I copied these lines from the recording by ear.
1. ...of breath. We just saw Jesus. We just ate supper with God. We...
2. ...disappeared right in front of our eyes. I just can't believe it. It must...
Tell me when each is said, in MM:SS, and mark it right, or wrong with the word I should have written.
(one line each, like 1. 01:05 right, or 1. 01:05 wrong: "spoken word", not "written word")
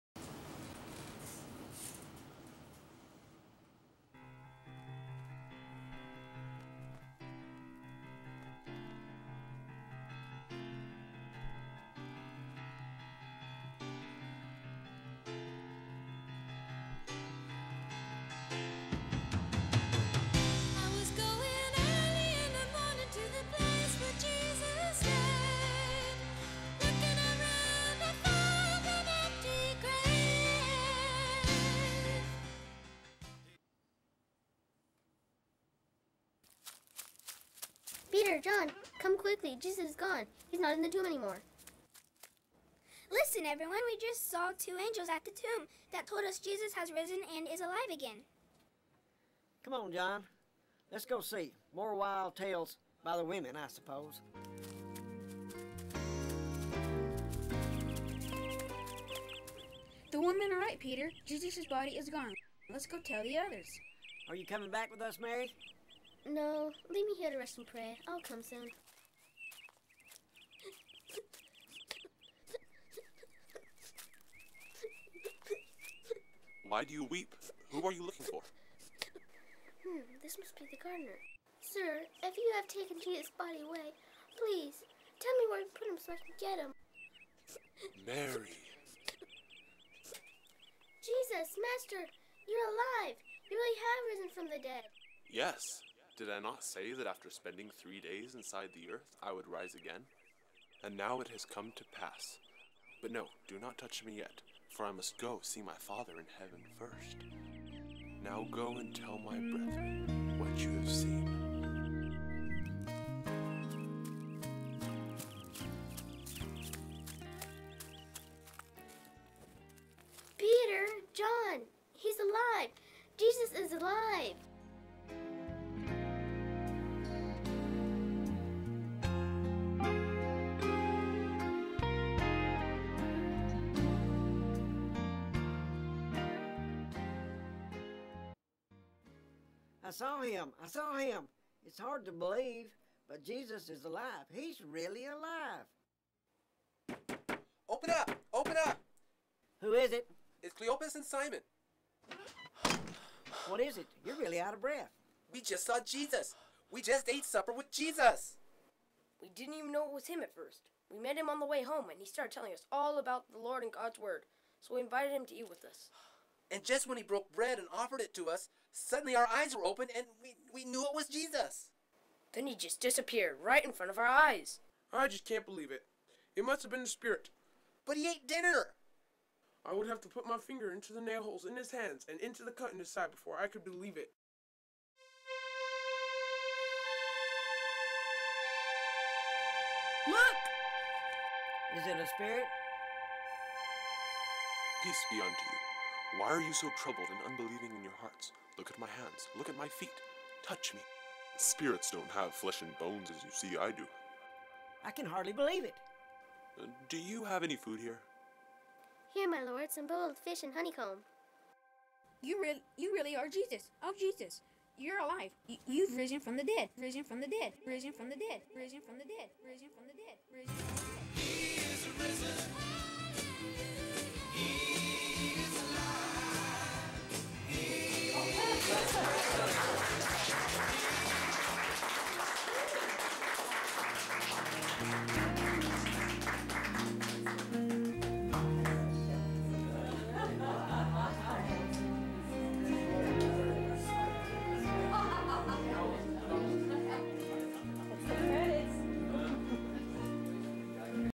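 1. 02:34 wrong: "Jesus", not "God"
2. 02:52 right.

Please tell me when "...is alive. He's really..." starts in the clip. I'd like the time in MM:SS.
02:23.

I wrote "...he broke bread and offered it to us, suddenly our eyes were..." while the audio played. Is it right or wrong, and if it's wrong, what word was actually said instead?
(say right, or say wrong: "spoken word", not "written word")
right.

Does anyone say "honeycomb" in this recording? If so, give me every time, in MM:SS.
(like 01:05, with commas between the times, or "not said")
03:30.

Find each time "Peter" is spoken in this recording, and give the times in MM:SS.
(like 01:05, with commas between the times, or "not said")
00:38, 01:00, 02:00.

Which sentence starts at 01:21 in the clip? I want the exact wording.
Sir, if you have taken Jesus' body away, please, tell me where you put him so I can get him.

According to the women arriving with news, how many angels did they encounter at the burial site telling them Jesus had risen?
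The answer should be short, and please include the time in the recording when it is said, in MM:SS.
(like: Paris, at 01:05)
2, at 00:44.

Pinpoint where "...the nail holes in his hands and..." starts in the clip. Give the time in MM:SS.
03:00.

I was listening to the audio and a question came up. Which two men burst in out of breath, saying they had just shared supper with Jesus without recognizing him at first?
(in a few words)
Cleopas and Simon.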